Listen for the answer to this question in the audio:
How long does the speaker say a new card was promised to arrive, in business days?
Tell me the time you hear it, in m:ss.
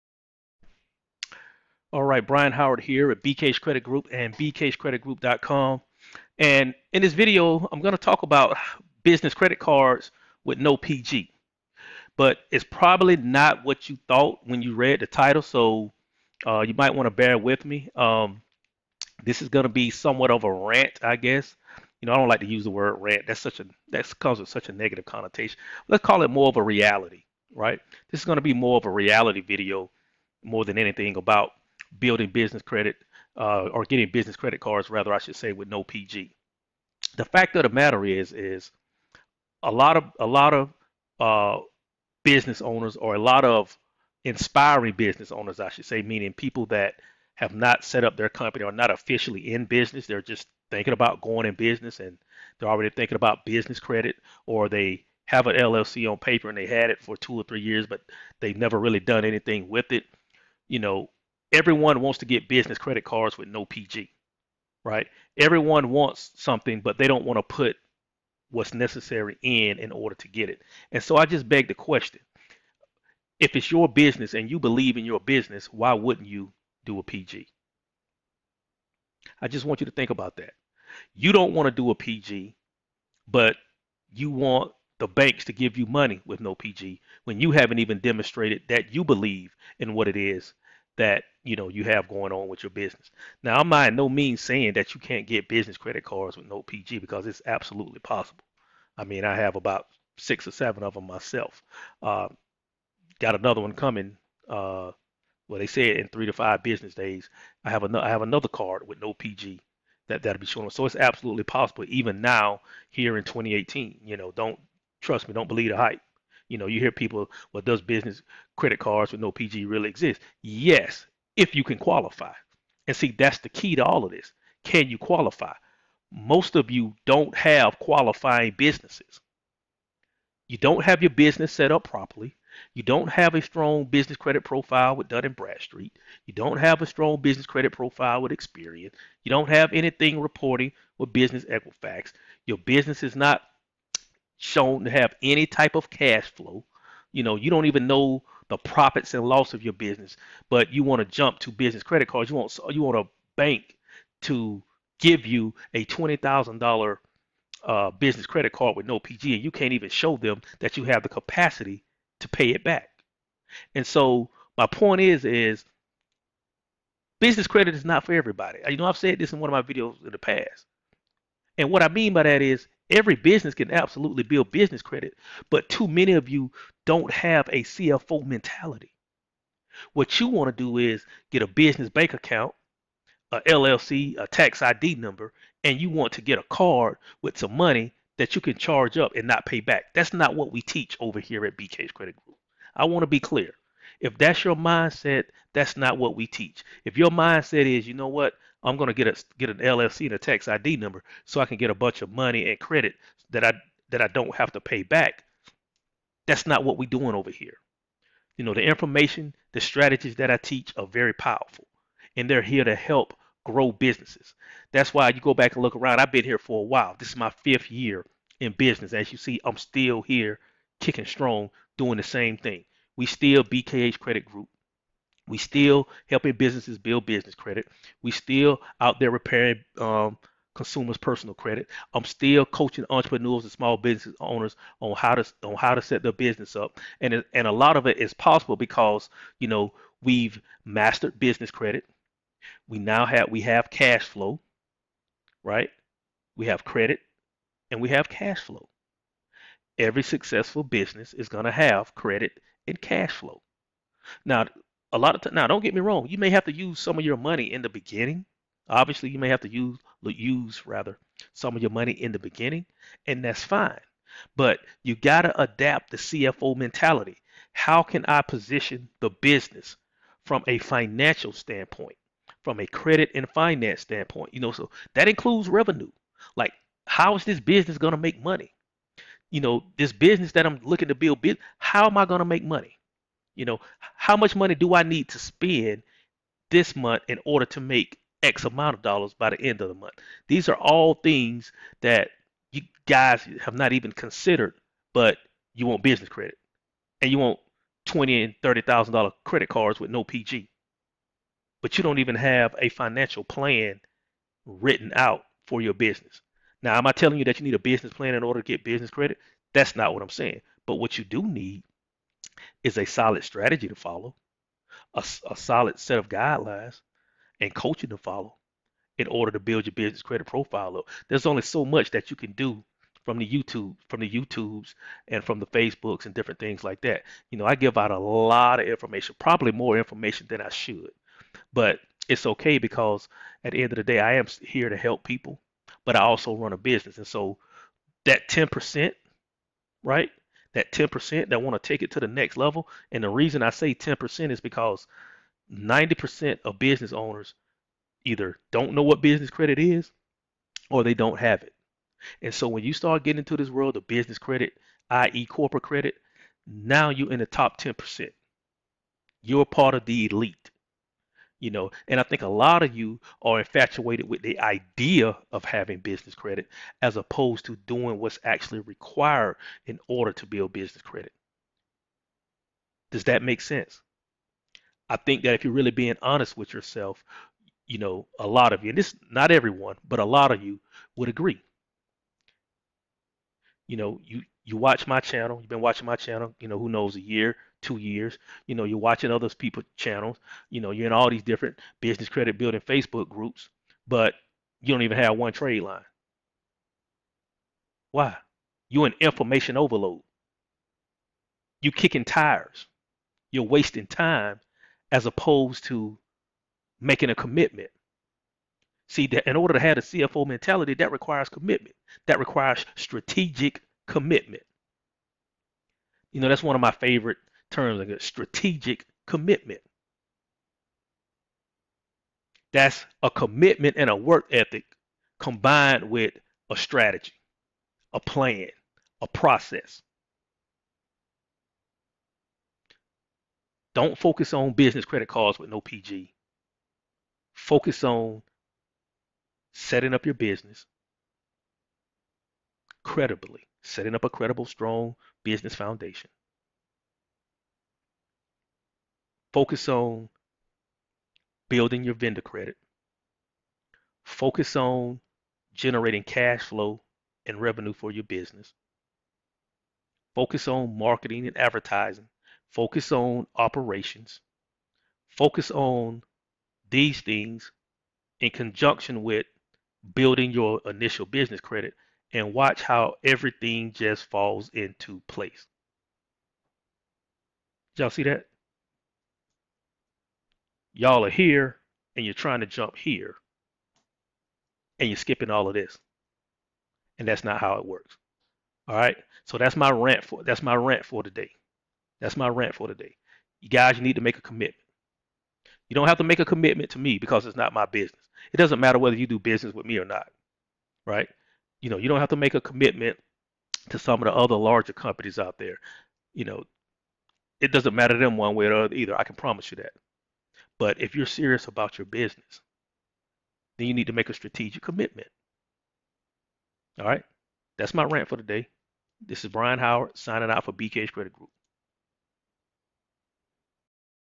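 1:46.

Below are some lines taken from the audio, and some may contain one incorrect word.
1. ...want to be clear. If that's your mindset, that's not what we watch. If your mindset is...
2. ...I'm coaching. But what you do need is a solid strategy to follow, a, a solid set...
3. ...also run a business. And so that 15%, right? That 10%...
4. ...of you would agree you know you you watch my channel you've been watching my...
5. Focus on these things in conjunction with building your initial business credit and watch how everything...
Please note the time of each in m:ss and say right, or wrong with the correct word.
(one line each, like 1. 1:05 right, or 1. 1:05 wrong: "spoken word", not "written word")
1. 3:12 wrong: "teach", not "watch"
2. 5:10 wrong: "saying", not "coaching"
3. 5:36 wrong: "10", not "15"
4. 6:20 right
5. 7:45 right.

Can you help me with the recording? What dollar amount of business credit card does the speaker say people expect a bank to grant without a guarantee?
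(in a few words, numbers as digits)
$20,000.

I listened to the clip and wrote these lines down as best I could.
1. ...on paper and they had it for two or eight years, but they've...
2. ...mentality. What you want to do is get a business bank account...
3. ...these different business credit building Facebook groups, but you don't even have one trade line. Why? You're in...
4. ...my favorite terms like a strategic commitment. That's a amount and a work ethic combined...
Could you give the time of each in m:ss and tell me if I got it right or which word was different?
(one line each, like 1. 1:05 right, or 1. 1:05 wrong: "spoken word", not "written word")
1. 0:56 wrong: "three", not "eight"
2. 2:58 right
3. 6:31 right
4. 6:56 wrong: "commitment", not "amount".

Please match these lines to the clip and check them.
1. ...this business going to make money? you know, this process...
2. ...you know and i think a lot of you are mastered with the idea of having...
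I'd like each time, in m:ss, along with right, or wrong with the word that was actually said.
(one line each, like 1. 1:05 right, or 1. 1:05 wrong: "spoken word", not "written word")
1. 4:37 wrong: "business", not "process"
2. 6:01 wrong: "infatuated", not "mastered".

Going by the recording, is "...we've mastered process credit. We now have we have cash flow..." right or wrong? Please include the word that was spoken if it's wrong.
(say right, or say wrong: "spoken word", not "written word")
wrong: "business", not "process".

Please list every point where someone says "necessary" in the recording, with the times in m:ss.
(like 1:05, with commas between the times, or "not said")
1:08.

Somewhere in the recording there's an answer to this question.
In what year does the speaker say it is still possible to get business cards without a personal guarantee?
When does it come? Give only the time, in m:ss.
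1:53.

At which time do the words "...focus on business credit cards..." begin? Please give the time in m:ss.
7:13.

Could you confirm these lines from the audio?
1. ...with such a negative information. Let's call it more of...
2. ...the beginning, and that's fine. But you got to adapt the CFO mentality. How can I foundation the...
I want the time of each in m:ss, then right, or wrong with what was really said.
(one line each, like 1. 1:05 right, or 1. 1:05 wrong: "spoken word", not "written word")
1. 0:24 wrong: "connotation", not "information"
2. 4:22 wrong: "position", not "foundation".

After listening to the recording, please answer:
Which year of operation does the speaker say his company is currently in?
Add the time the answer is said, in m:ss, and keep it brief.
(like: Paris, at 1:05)
Fifth year, at 3:37.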